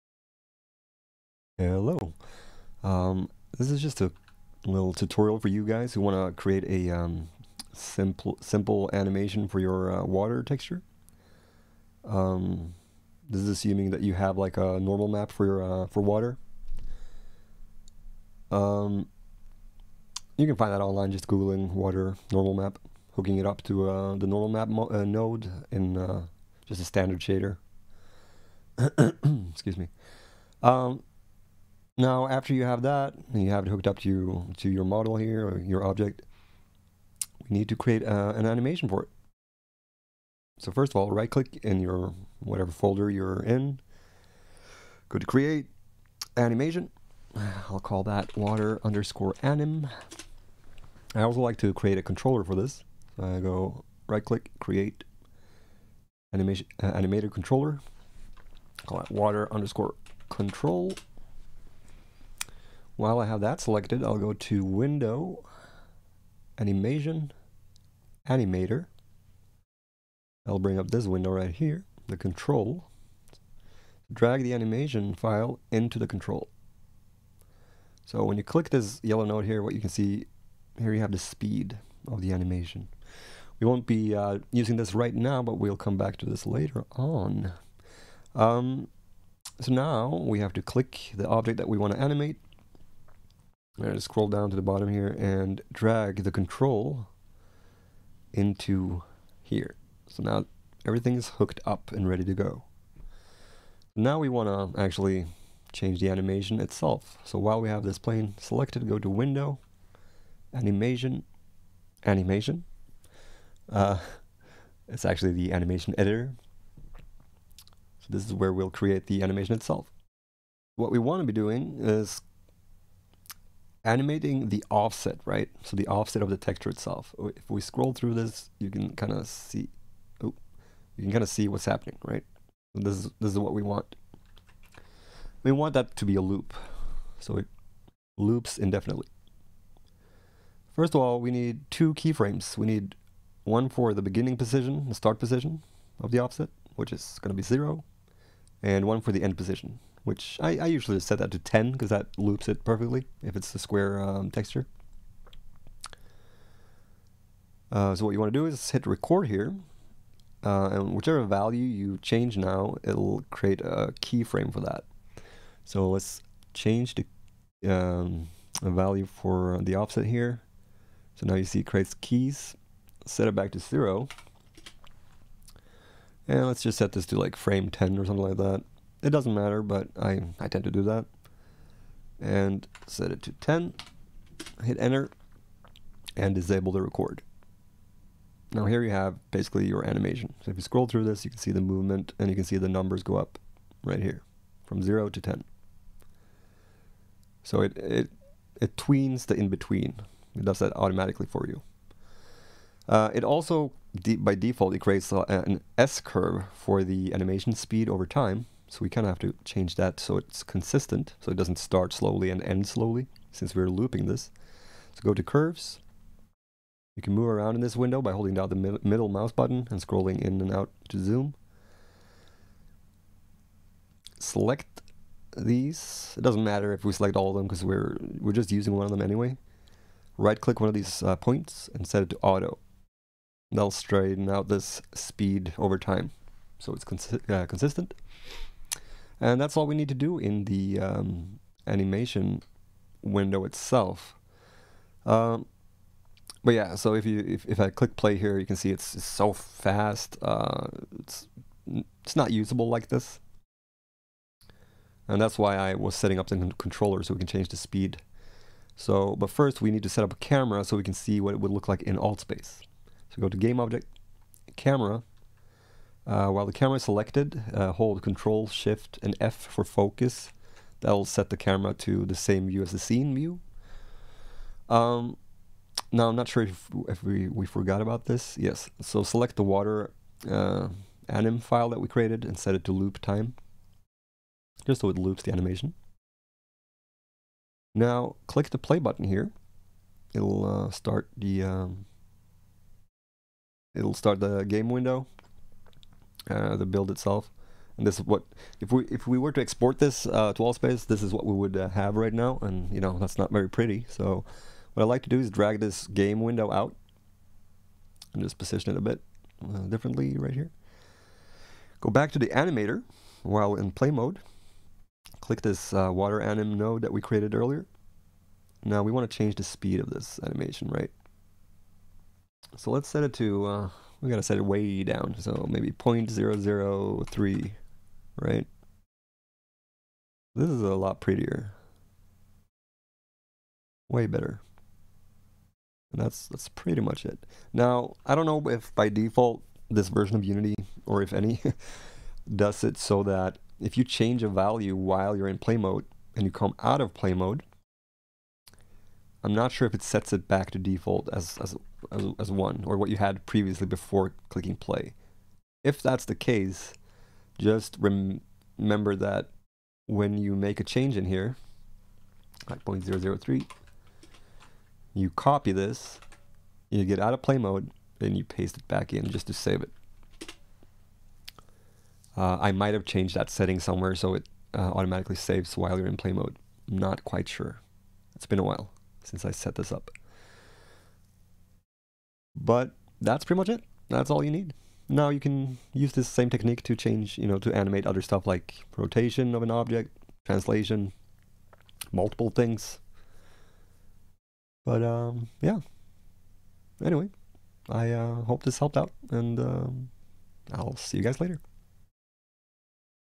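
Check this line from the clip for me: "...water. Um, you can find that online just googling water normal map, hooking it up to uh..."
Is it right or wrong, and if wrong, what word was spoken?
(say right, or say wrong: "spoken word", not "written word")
right.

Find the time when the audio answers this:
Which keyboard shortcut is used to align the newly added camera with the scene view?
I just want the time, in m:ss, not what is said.
4:28.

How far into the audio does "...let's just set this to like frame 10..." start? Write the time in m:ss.
2:56.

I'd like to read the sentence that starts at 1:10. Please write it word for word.
I'll bring up this window right here, the control.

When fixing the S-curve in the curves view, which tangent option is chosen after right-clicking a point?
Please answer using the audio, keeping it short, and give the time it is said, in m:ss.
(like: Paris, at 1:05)
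auto, at 3:52.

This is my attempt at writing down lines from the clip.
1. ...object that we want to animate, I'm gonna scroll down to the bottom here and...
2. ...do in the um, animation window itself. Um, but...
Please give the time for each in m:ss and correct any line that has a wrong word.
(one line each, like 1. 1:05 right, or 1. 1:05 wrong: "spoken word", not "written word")
1. 1:31 right
2. 3:59 right.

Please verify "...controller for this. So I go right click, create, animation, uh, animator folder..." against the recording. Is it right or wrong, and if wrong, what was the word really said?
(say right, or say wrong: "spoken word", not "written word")
wrong: "controller", not "folder".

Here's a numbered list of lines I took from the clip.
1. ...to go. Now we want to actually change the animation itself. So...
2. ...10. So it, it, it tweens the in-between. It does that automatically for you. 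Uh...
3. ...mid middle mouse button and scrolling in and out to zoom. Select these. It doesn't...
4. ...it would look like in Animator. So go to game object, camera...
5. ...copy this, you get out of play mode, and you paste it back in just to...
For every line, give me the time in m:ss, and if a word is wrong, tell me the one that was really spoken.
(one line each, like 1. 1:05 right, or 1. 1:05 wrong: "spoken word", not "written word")
1. 1:42 right
2. 3:15 right
3. 3:38 right
4. 4:21 wrong: "Altspace", not "Animator"
5. 6:05 right.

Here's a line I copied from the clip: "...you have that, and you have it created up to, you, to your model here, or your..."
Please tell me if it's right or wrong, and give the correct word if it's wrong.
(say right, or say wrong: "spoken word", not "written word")
wrong: "hooked", not "created".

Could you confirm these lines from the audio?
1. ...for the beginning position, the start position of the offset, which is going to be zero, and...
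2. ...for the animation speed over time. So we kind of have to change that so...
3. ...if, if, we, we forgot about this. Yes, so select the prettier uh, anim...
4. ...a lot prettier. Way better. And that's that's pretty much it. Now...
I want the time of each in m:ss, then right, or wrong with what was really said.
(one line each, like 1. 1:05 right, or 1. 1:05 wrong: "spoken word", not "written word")
1. 2:23 right
2. 3:26 right
3. 4:36 wrong: "water", not "prettier"
4. 5:30 right.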